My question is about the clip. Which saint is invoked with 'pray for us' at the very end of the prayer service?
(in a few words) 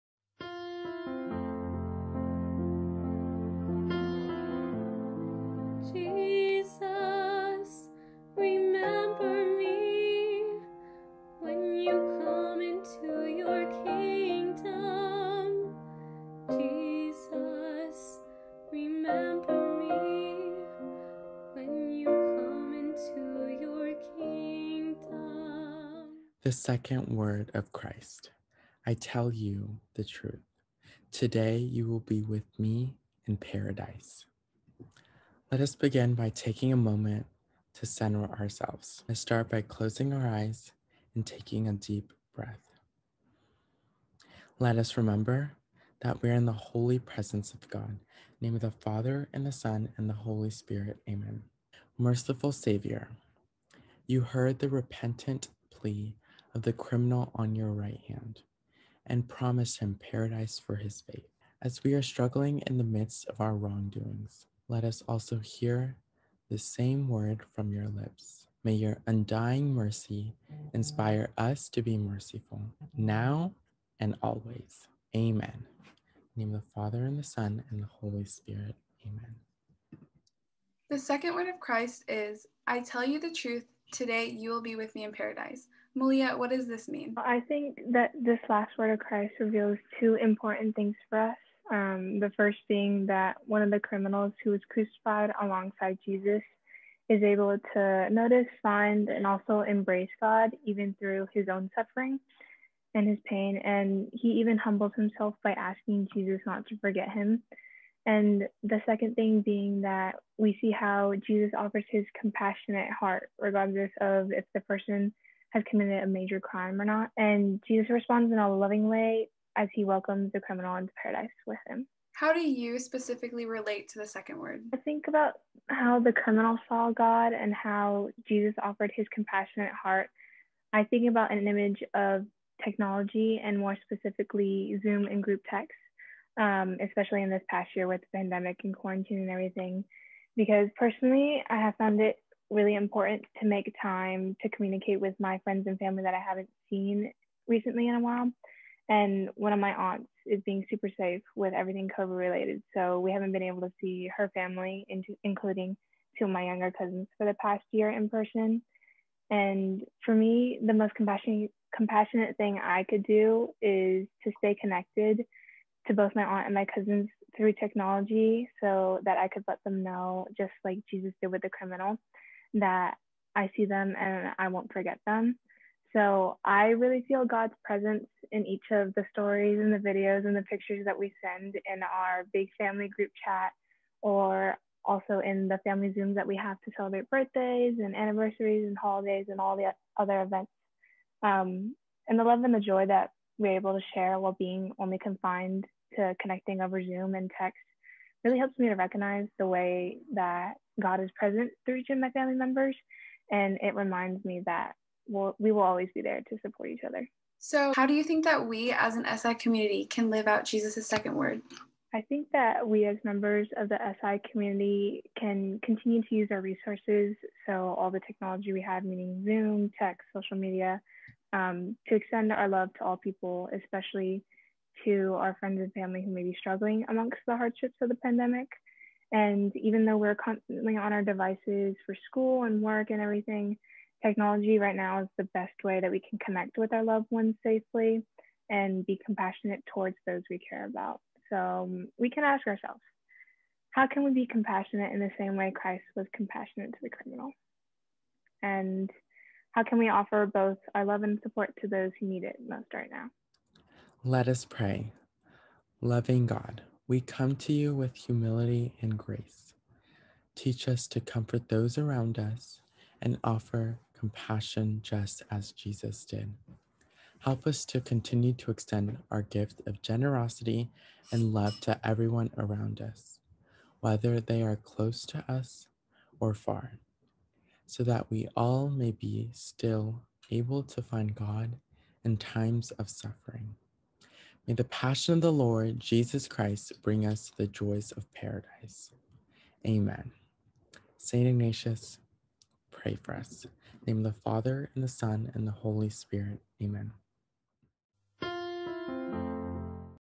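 St. Ignatius.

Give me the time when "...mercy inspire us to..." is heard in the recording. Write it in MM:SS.
01:09.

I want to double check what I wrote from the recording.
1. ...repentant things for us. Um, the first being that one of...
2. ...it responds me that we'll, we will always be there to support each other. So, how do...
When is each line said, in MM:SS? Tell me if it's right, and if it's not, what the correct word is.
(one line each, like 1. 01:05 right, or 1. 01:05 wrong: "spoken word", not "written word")
1. 01:30 wrong: "important", not "repentant"
2. 03:23 wrong: "reminds", not "responds".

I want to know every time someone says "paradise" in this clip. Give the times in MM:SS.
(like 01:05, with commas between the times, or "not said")
00:33, 01:00, 01:25, 02:01, 04:48.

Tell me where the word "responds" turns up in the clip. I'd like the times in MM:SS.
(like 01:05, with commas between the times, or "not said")
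01:57.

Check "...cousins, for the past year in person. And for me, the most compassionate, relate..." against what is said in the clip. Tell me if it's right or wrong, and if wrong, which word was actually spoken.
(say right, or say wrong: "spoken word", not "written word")
wrong: "compassionate", not "relate".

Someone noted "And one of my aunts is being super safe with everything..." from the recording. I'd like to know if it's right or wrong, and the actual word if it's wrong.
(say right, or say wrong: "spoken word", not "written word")
right.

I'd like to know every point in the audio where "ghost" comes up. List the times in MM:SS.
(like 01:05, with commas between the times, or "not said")
not said.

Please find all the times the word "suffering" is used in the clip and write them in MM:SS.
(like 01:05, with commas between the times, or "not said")
01:41, 04:42.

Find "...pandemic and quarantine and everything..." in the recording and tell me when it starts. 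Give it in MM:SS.
02:18.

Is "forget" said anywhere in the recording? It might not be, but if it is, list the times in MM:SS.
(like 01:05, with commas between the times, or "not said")
01:46, 02:54.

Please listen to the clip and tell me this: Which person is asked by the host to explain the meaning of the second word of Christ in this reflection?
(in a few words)
Malia.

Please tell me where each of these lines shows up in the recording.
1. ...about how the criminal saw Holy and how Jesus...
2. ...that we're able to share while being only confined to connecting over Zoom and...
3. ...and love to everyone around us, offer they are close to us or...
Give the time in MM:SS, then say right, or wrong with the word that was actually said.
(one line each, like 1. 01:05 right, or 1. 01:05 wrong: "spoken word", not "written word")
1. 02:05 wrong: "God", not "Holy"
2. 03:12 right
3. 04:31 wrong: "whether", not "offer".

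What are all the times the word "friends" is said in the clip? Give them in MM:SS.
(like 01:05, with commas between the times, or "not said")
02:25, 03:45.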